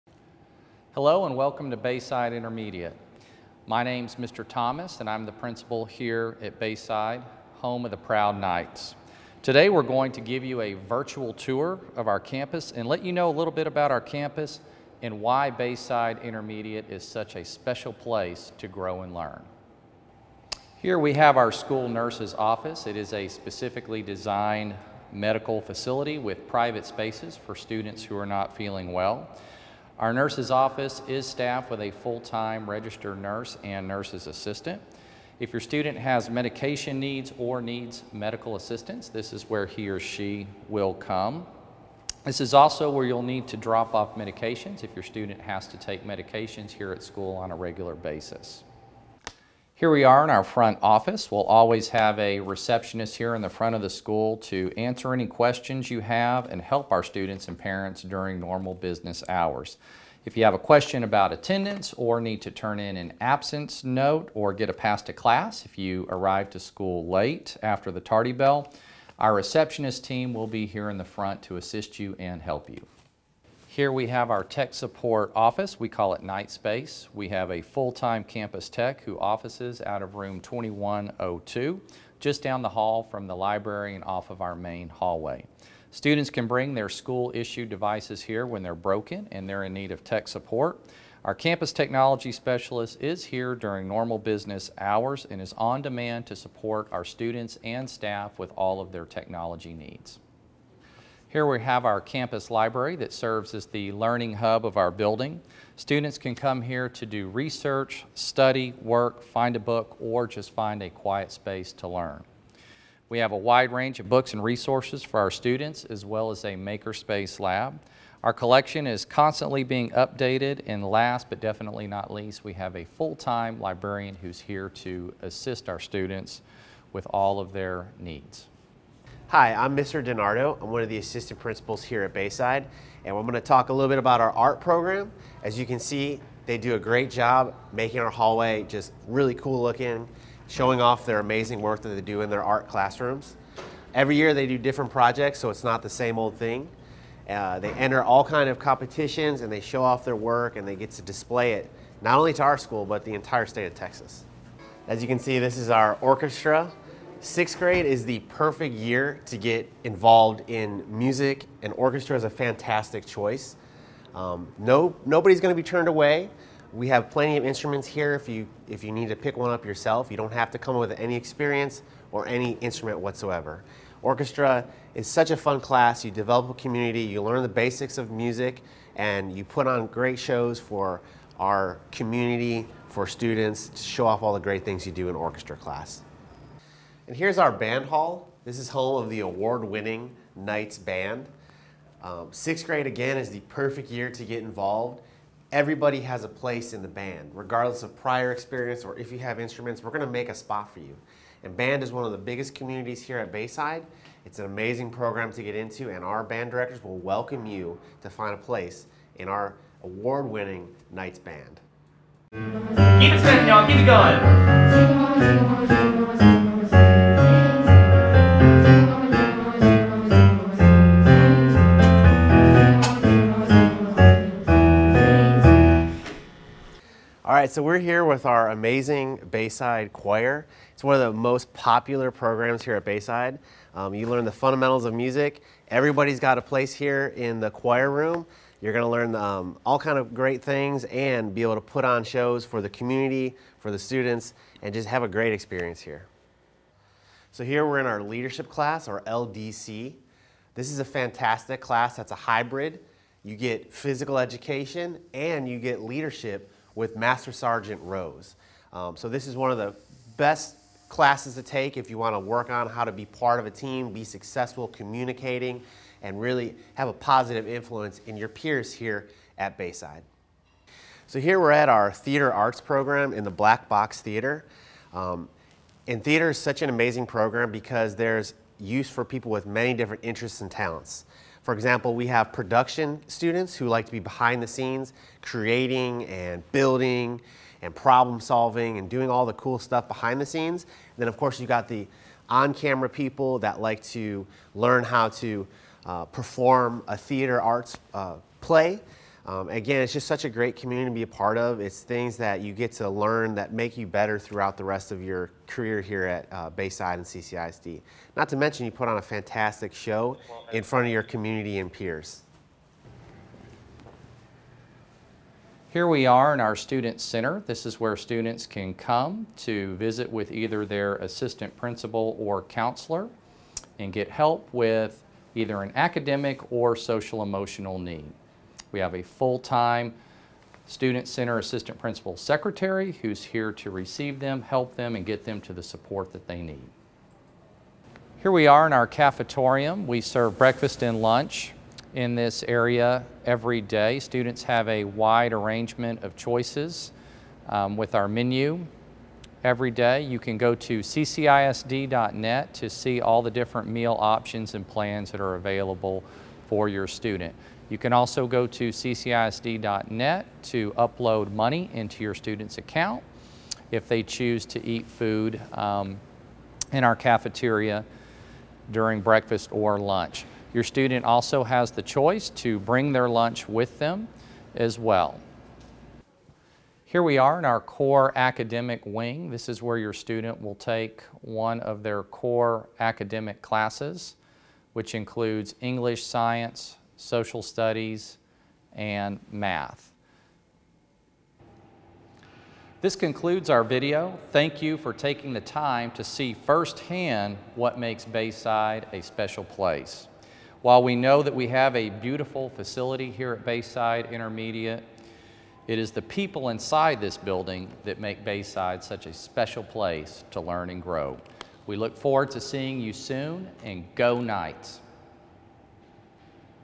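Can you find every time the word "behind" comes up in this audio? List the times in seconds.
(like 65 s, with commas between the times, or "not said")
283 s, 289 s.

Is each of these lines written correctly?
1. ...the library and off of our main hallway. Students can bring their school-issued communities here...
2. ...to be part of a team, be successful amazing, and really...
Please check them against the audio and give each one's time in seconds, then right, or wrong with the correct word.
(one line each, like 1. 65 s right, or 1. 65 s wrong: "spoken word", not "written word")
1. 83 s wrong: "devices", not "communities"
2. 262 s wrong: "communicating", not "amazing".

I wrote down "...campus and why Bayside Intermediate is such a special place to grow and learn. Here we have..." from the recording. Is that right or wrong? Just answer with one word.
right.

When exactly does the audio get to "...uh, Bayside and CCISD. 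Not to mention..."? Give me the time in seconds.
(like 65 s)
306 s.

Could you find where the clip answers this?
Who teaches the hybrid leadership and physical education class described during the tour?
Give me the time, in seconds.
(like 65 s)
256 s.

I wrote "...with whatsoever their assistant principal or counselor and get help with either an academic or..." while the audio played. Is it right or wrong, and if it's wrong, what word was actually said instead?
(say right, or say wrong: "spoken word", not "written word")
wrong: "either", not "whatsoever".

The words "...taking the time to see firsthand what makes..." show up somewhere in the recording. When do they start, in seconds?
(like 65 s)
394 s.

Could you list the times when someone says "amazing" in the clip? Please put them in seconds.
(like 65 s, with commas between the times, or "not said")
141 s, 204 s, 228 s, 276 s.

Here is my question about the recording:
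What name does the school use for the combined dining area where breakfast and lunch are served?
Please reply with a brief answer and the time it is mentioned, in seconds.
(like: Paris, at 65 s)
cafetorium, at 338 s.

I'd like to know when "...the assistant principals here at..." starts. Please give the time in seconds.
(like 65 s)
130 s.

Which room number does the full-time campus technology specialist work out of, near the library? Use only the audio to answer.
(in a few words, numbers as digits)
2102.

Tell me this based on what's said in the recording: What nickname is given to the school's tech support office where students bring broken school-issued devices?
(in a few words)
Nightspace.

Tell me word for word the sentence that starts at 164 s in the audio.
Um, no, nobody's going to be turned away.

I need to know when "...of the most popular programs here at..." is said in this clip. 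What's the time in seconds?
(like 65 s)
230 s.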